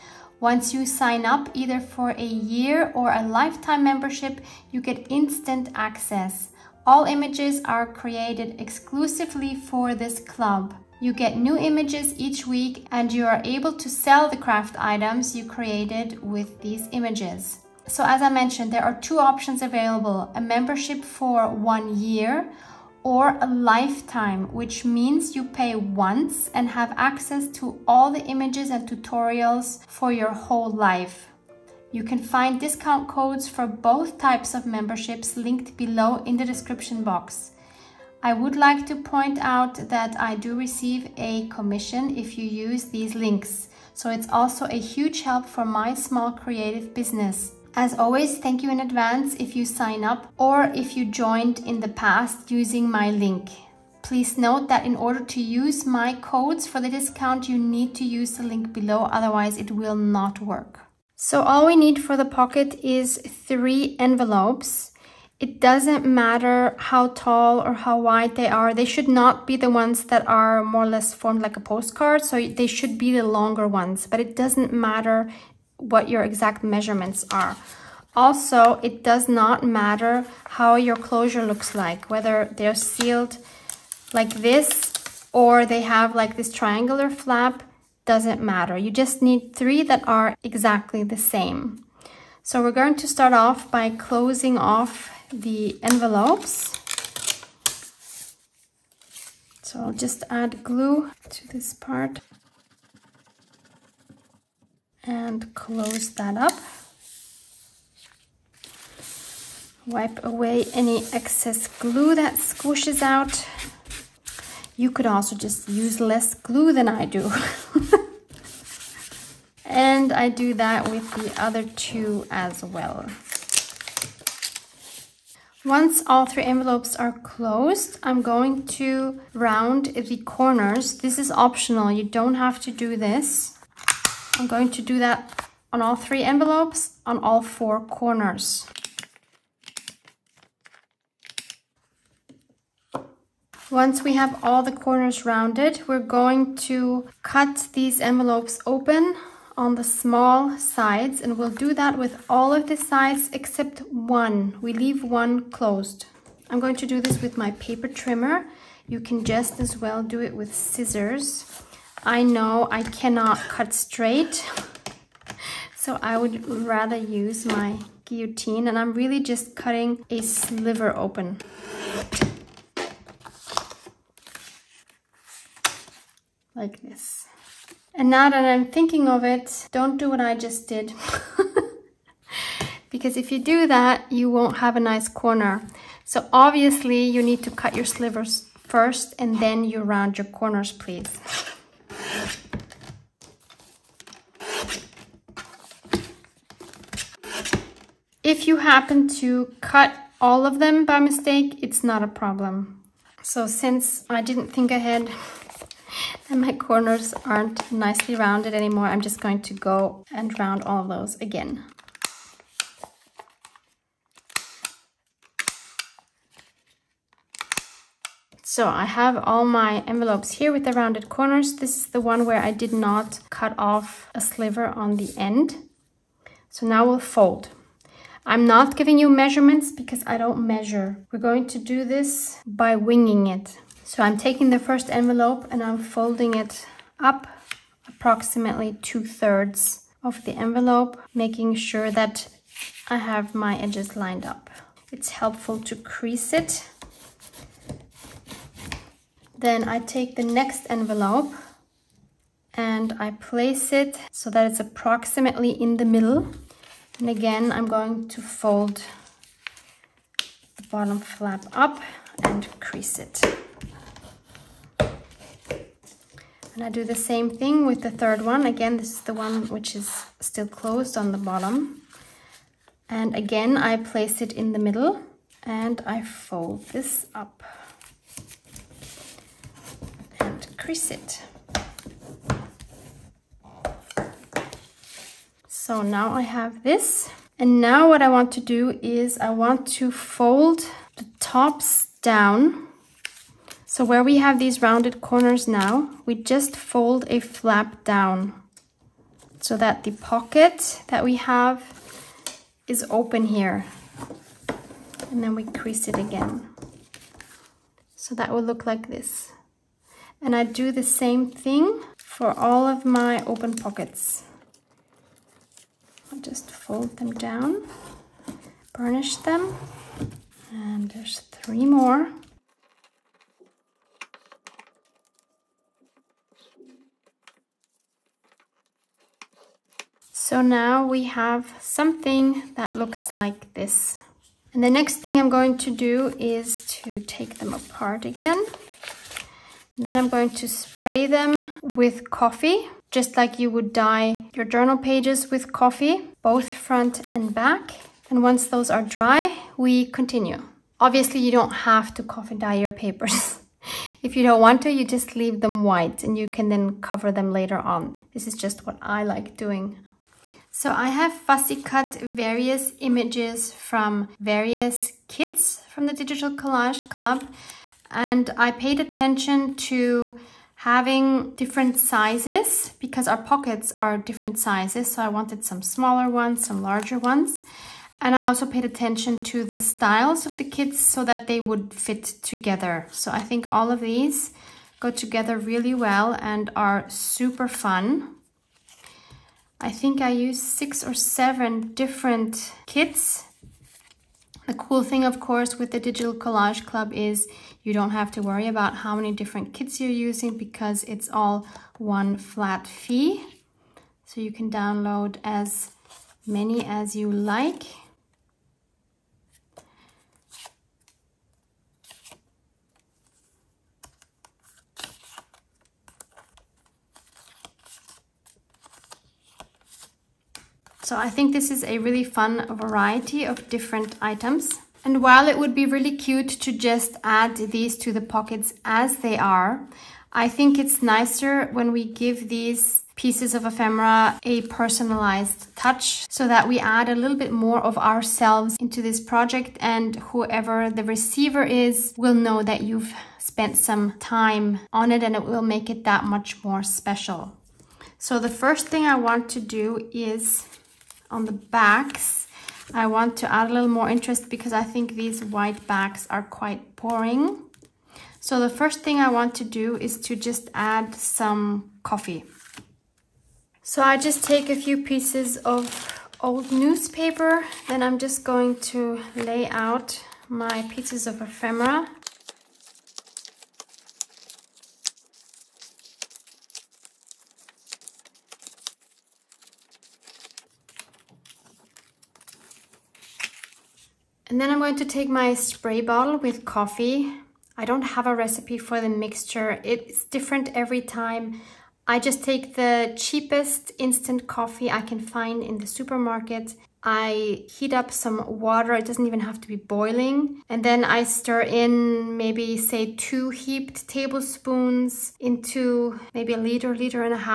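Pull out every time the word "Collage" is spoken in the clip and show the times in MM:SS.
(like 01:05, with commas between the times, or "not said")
06:06, 06:36.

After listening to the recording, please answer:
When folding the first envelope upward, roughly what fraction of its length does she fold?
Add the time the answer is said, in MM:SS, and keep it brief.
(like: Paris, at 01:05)
two thirds, at 03:58.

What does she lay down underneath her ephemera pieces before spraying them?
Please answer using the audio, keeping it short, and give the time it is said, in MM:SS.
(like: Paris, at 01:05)
old newspaper, at 07:46.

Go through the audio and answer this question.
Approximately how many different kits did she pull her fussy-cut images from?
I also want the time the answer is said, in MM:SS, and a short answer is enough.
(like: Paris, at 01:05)
6 or 7, at 06:30.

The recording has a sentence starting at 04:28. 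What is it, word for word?
Again, this is the one which is still closed on the bottom.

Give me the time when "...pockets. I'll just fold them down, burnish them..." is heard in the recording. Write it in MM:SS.
05:13.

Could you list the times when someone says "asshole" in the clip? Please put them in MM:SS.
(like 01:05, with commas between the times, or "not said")
not said.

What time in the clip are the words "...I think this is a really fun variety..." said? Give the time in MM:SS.
07:00.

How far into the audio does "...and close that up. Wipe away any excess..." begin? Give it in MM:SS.
01:45.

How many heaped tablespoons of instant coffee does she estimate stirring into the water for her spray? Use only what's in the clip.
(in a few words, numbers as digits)
2.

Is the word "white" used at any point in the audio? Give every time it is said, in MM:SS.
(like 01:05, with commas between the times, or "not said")
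05:55, 07:35.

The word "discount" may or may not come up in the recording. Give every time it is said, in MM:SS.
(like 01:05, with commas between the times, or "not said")
00:32, 00:56.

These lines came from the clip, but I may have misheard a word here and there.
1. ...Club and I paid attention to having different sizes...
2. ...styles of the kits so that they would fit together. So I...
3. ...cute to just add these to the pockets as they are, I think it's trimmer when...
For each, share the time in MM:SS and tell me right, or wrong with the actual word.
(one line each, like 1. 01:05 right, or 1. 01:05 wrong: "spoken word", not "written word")
1. 06:06 right
2. 06:19 right
3. 07:05 wrong: "nicer", not "trimmer".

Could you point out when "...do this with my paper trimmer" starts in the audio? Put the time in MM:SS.
02:36.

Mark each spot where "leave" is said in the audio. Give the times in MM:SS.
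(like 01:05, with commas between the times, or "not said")
02:34, 05:55.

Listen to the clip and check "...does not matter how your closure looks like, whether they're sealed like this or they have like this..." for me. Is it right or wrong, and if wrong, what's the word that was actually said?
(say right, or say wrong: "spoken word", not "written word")
right.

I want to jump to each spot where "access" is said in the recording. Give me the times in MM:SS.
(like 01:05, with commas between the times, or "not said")
00:05, 00:26.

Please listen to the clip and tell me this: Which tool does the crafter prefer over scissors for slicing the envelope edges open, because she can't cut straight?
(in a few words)
guillotine.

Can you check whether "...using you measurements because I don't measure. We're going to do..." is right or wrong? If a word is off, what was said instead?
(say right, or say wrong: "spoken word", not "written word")
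wrong: "giving", not "using".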